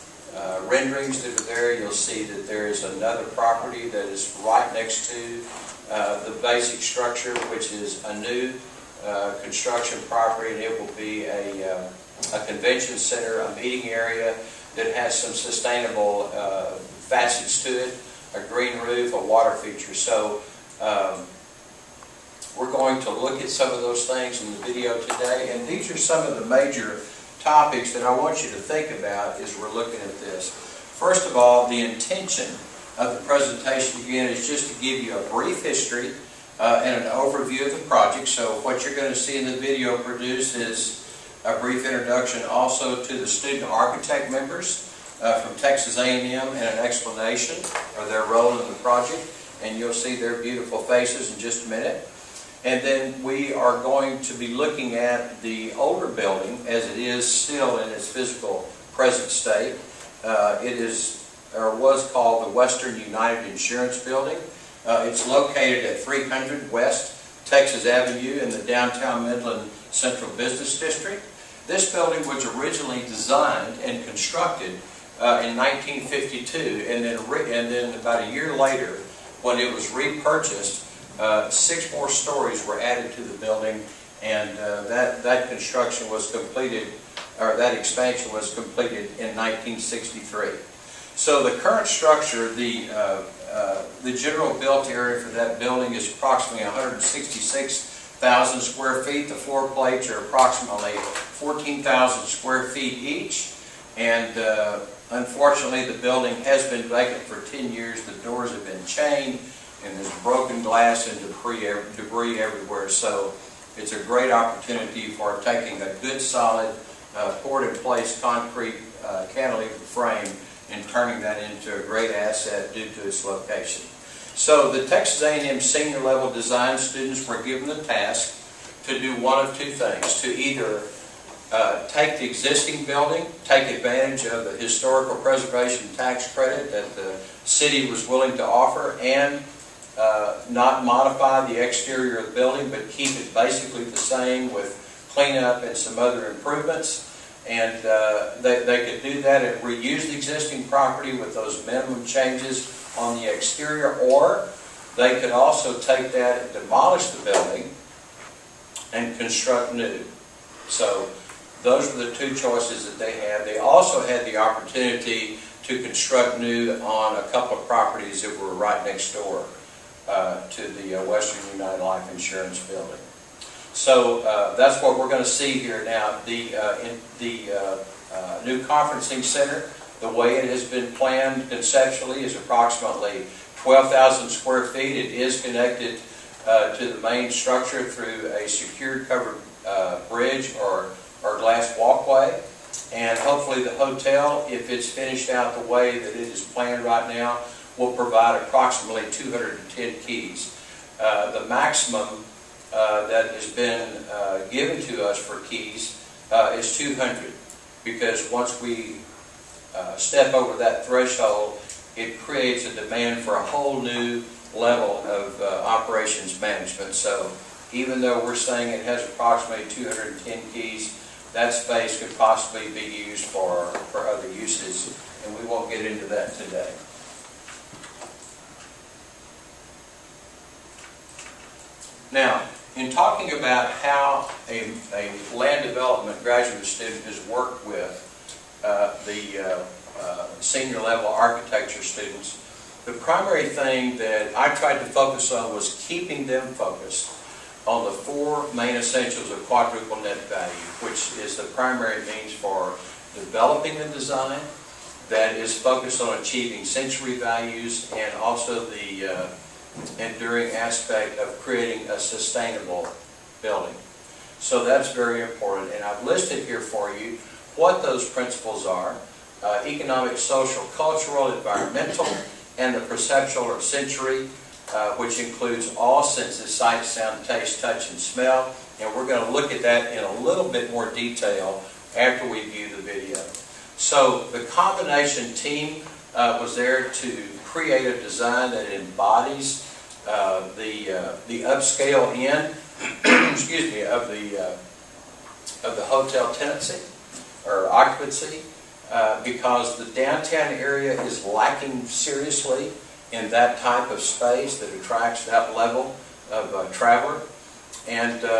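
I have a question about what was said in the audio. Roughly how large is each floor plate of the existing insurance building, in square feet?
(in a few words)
14,000 square feet.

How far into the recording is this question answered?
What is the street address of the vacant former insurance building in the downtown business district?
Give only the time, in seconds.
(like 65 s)
66 s.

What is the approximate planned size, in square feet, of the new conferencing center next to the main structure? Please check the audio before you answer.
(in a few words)
12,000 square feet.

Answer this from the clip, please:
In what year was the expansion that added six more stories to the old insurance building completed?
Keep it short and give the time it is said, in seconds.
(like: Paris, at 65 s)
1963, at 89 s.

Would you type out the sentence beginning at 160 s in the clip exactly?
So those were the two choices that they had.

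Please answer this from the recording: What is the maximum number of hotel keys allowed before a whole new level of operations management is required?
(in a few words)
200.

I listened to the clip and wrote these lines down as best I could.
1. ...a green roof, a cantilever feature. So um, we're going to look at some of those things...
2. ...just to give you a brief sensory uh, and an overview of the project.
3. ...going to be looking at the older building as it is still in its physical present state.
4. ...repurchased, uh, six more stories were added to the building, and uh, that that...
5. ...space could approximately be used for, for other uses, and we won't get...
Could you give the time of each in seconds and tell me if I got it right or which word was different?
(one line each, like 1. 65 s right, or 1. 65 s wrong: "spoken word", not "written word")
1. 18 s wrong: "water", not "cantilever"
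2. 34 s wrong: "history", not "sensory"
3. 53 s right
4. 79 s right
5. 221 s wrong: "possibly", not "approximately".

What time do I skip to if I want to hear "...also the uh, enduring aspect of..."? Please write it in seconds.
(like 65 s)
258 s.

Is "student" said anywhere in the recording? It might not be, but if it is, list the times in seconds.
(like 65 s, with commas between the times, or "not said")
43 s, 126 s, 236 s, 241 s.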